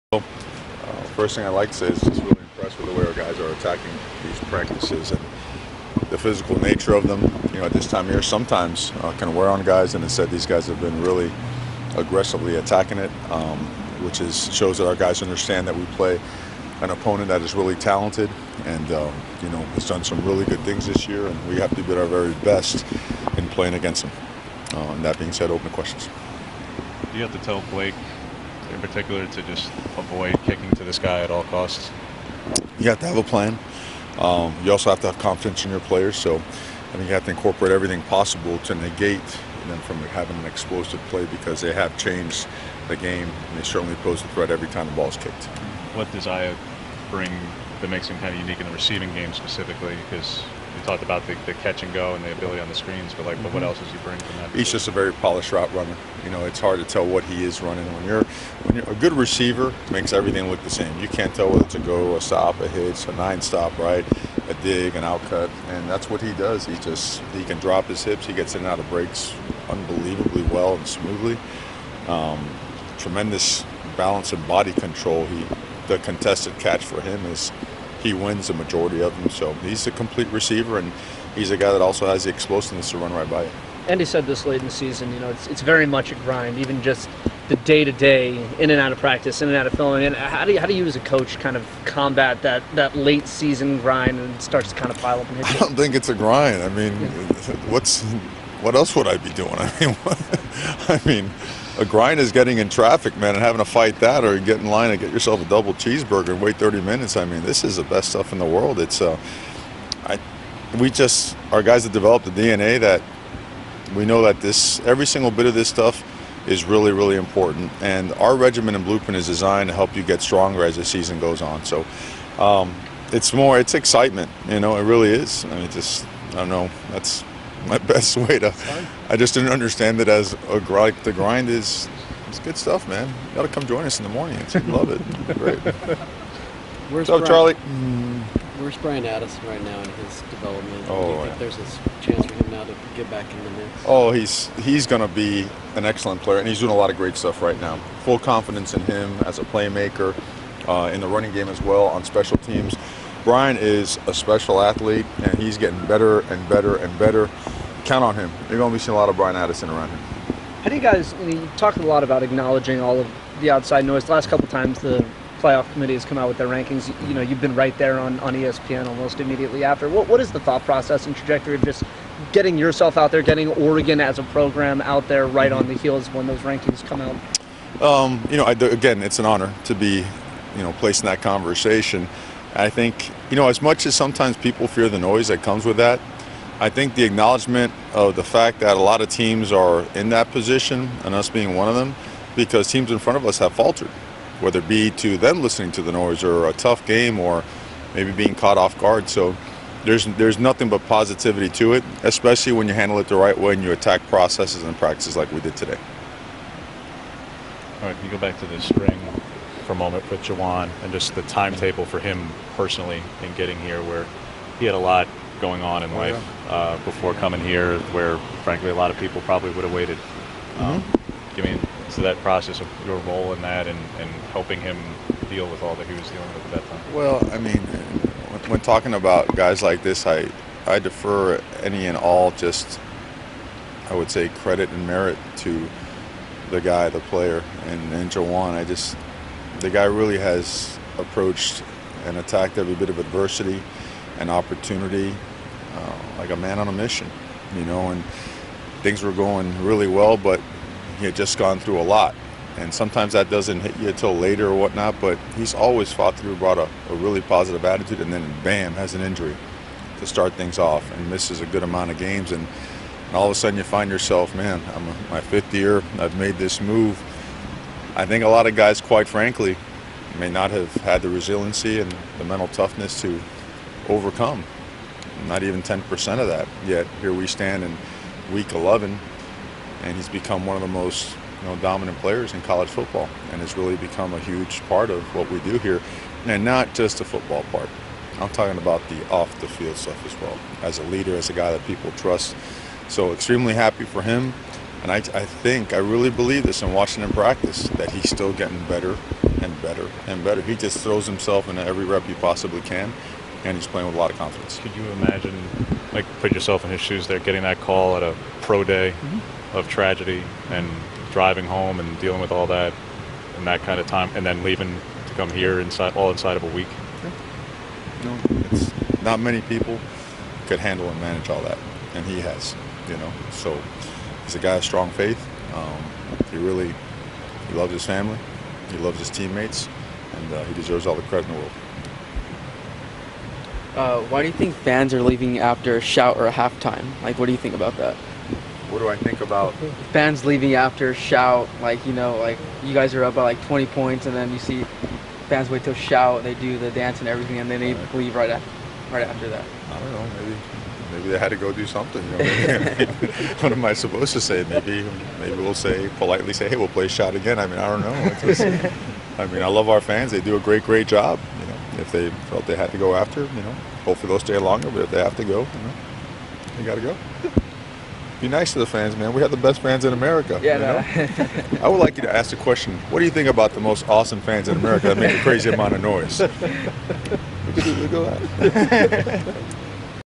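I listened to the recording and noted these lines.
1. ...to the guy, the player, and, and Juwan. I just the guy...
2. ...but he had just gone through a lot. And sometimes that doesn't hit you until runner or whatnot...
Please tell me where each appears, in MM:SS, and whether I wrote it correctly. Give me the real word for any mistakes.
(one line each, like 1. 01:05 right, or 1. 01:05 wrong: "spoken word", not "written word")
1. 03:55 right
2. 04:10 wrong: "later", not "runner".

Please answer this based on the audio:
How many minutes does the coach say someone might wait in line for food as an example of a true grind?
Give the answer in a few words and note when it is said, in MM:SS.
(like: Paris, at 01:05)
30, at 01:46.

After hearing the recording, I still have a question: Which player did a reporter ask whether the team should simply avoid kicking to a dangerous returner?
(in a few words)
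Blake.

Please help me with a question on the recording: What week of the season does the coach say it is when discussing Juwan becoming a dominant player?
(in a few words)
week 11.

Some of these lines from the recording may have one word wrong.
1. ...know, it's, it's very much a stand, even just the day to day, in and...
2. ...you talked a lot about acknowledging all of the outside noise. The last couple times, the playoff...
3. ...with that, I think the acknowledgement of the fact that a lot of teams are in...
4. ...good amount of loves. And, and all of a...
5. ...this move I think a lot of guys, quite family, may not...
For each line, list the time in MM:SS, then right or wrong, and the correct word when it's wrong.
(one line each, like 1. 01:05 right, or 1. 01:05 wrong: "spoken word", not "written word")
1. 01:25 wrong: "grind", not "stand"
2. 02:41 right
3. 03:05 right
4. 04:21 wrong: "games", not "loves"
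5. 04:26 wrong: "frankly", not "family".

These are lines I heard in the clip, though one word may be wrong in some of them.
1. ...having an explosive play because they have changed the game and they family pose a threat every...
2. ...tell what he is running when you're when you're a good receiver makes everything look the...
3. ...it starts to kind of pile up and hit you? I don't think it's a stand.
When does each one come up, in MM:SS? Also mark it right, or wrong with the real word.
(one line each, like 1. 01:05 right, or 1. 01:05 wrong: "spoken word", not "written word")
1. 00:39 wrong: "certainly", not "family"
2. 00:56 right
3. 01:34 wrong: "grind", not "stand".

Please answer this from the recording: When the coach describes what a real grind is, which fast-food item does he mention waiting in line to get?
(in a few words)
double cheeseburger.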